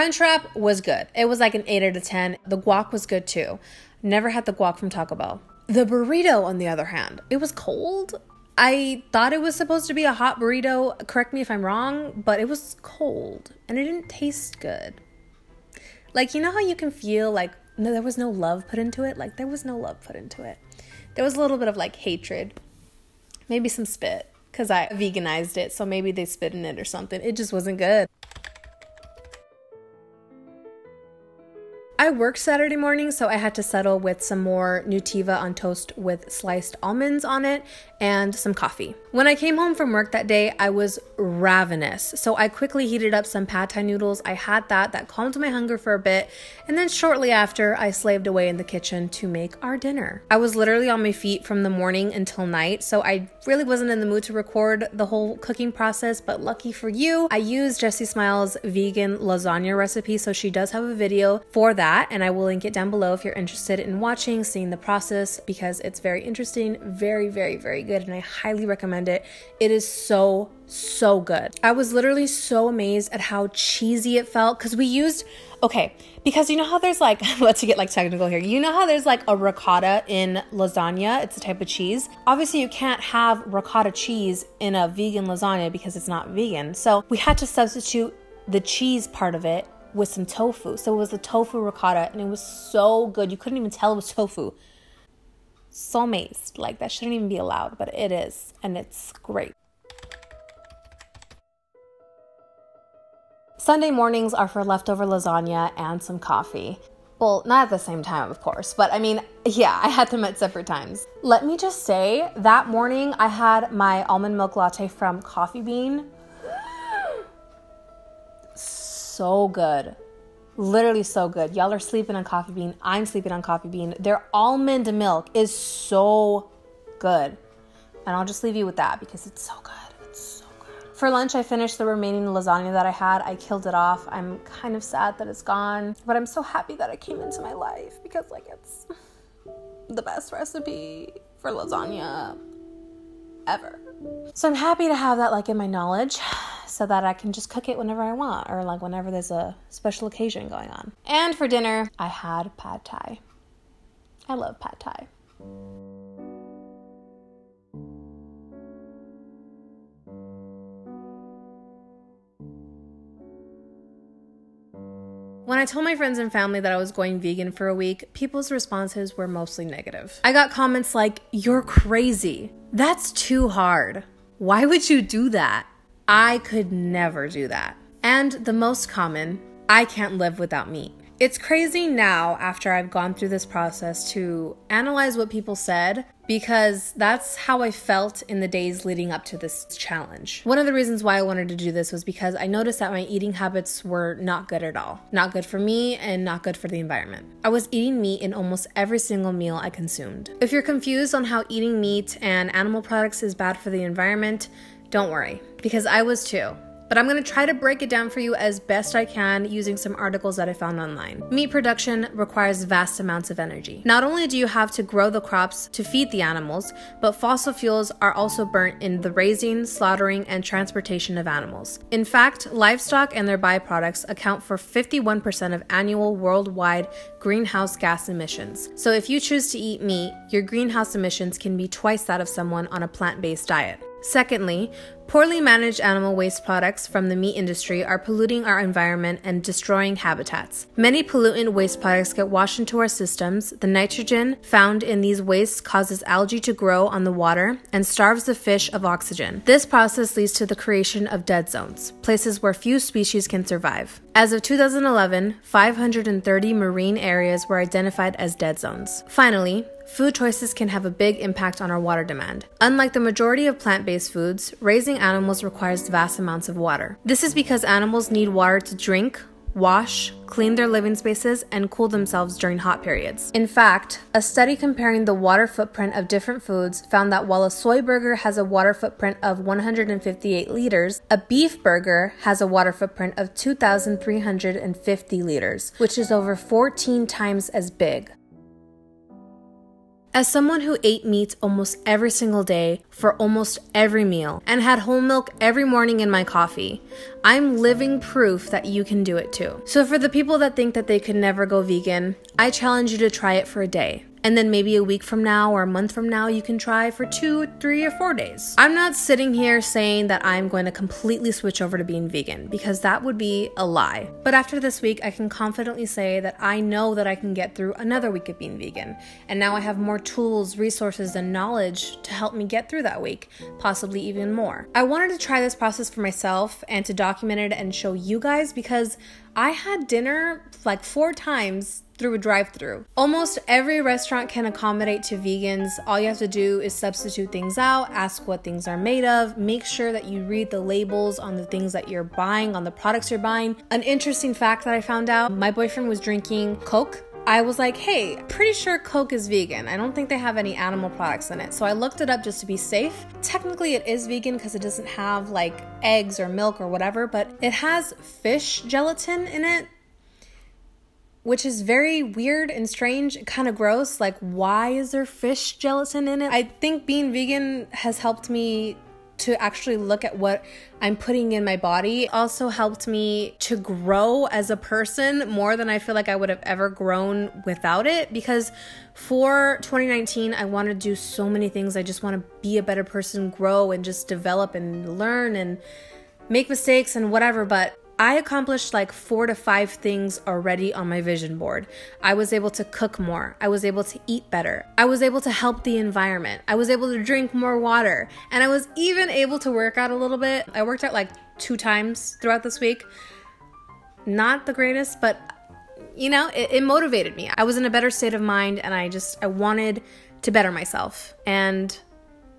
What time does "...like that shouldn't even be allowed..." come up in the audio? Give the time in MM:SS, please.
01:36.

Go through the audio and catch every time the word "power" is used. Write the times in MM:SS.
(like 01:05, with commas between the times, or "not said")
not said.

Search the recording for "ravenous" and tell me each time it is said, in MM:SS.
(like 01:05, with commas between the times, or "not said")
00:41.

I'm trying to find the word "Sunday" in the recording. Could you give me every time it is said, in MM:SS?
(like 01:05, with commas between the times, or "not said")
01:43.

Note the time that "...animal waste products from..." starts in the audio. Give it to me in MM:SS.
03:55.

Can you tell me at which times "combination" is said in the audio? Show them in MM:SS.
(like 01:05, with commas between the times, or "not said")
not said.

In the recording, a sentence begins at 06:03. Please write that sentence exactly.
Like, why is there fish gelatin in it?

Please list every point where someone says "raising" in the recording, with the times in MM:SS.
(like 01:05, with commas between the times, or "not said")
03:39, 04:24.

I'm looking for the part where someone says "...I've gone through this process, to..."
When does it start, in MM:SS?
03:02.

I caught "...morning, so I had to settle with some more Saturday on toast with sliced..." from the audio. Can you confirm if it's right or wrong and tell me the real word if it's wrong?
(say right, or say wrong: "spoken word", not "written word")
wrong: "Nutiva", not "Saturday".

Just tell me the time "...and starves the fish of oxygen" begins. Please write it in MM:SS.
04:07.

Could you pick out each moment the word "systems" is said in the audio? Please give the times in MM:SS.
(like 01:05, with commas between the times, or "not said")
04:02.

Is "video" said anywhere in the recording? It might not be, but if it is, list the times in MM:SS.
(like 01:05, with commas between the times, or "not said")
01:00.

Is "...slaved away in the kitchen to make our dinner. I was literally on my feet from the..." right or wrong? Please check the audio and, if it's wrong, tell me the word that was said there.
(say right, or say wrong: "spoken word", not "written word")
right.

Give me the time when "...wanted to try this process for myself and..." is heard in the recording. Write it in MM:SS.
05:24.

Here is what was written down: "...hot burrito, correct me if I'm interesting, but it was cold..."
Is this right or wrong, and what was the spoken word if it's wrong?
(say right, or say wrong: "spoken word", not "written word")
wrong: "wrong", not "interesting".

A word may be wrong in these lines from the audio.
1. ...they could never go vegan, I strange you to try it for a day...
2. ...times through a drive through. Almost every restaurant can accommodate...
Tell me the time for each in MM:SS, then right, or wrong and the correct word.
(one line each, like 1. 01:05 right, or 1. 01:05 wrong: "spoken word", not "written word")
1. 05:00 wrong: "challenge", not "strange"
2. 05:31 right.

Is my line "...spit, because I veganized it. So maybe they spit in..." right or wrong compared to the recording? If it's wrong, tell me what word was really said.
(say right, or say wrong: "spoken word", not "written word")
right.